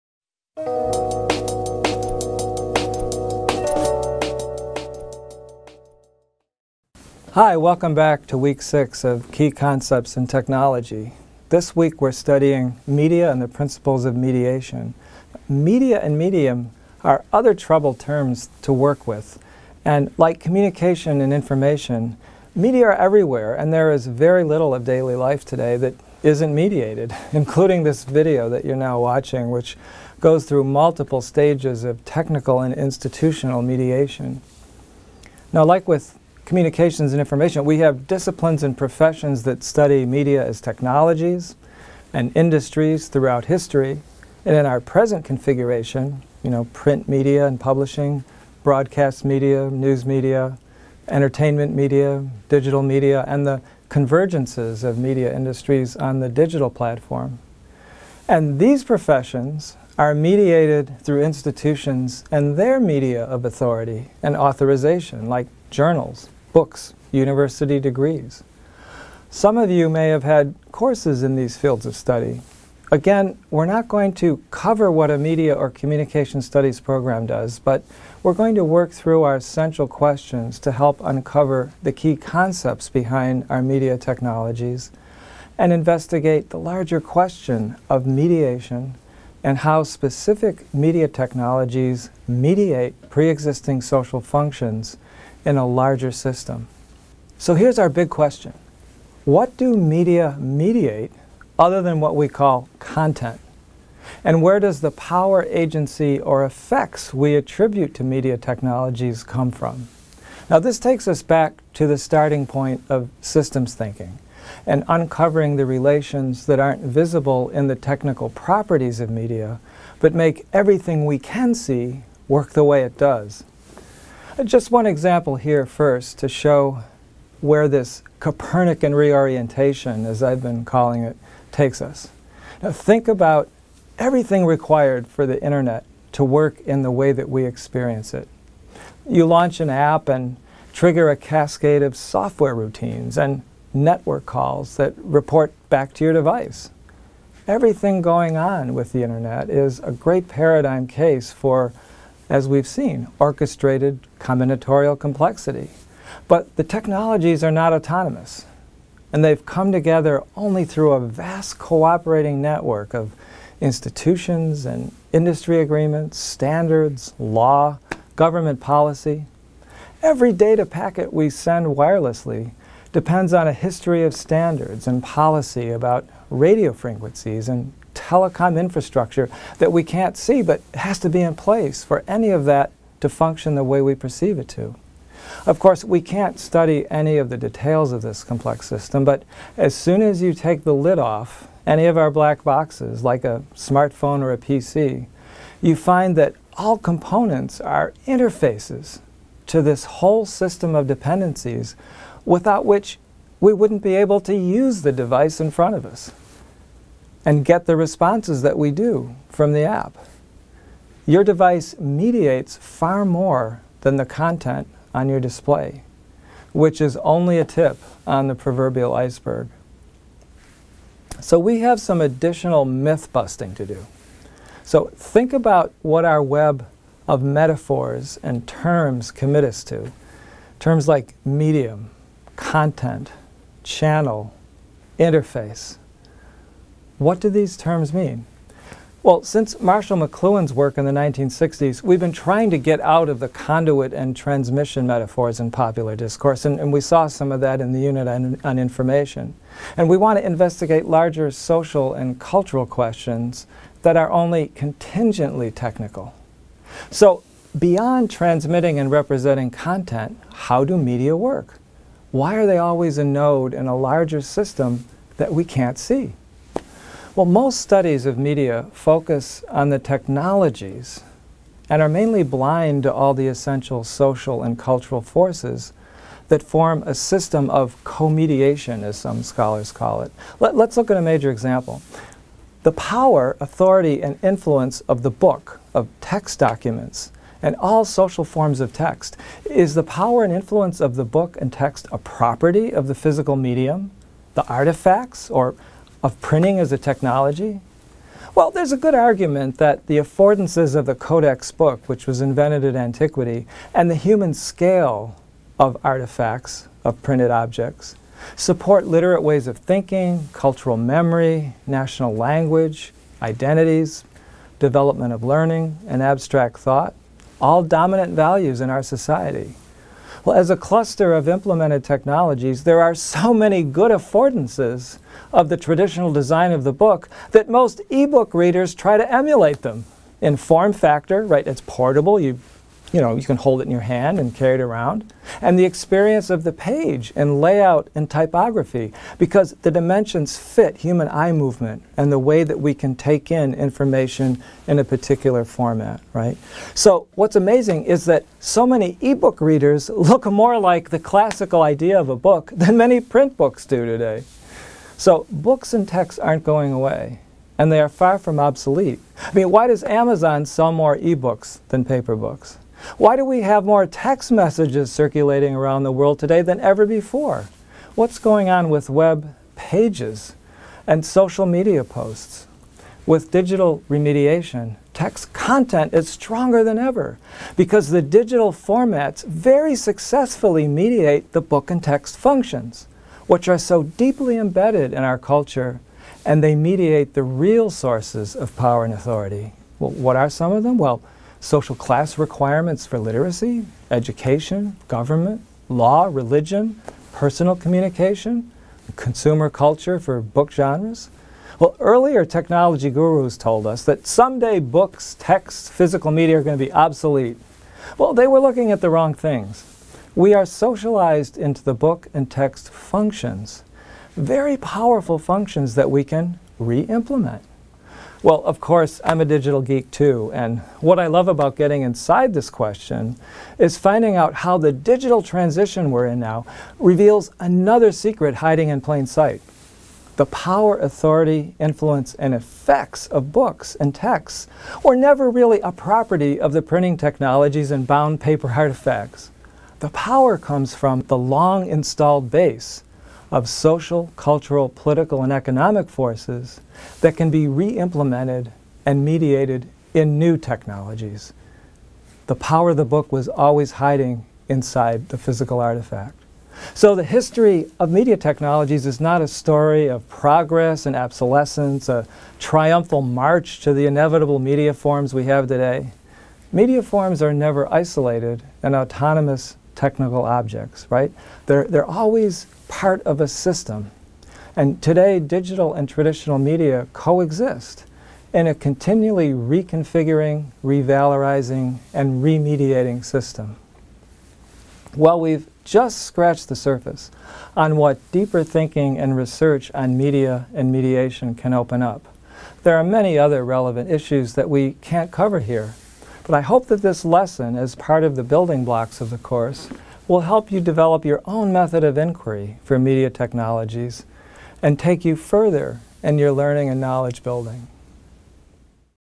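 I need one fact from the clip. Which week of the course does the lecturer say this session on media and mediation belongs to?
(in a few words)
week six.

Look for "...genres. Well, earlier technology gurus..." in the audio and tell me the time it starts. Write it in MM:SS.
06:40.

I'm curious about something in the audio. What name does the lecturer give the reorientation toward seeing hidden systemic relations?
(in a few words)
Copernican.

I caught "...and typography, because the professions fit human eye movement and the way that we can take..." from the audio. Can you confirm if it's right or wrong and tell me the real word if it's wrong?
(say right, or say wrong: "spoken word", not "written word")
wrong: "dimensions", not "professions".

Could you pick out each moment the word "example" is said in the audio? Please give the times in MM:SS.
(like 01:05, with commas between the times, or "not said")
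02:04, 04:41.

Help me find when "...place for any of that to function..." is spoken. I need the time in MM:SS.
03:01.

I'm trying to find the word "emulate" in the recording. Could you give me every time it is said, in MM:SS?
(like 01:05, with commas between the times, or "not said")
05:29.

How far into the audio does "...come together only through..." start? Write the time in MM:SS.
02:39.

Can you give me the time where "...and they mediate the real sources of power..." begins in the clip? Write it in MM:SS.
06:26.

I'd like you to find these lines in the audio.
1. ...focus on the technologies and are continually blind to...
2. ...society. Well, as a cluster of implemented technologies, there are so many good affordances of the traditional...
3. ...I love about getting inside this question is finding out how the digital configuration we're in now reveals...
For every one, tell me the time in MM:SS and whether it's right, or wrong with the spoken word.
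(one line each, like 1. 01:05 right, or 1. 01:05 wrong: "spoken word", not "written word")
1. 04:28 wrong: "mainly", not "continually"
2. 05:18 right
3. 07:00 wrong: "transition", not "configuration".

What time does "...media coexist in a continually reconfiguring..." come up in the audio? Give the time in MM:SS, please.
07:56.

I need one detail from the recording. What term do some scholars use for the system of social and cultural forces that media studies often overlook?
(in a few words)
co-mediation.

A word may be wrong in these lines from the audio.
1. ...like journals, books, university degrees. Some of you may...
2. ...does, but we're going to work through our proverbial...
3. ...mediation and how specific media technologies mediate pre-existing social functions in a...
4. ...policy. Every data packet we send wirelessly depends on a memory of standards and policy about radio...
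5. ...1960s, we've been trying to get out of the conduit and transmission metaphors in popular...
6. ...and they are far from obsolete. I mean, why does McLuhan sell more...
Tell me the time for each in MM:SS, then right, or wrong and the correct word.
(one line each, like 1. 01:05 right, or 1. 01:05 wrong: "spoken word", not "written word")
1. 01:05 right
2. 01:17 wrong: "central", not "proverbial"
3. 01:28 right
4. 02:48 wrong: "history", not "memory"
5. 04:00 right
6. 05:57 wrong: "Amazon", not "McLuhan".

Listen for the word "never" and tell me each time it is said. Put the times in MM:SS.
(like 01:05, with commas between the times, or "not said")
07:14, 07:47.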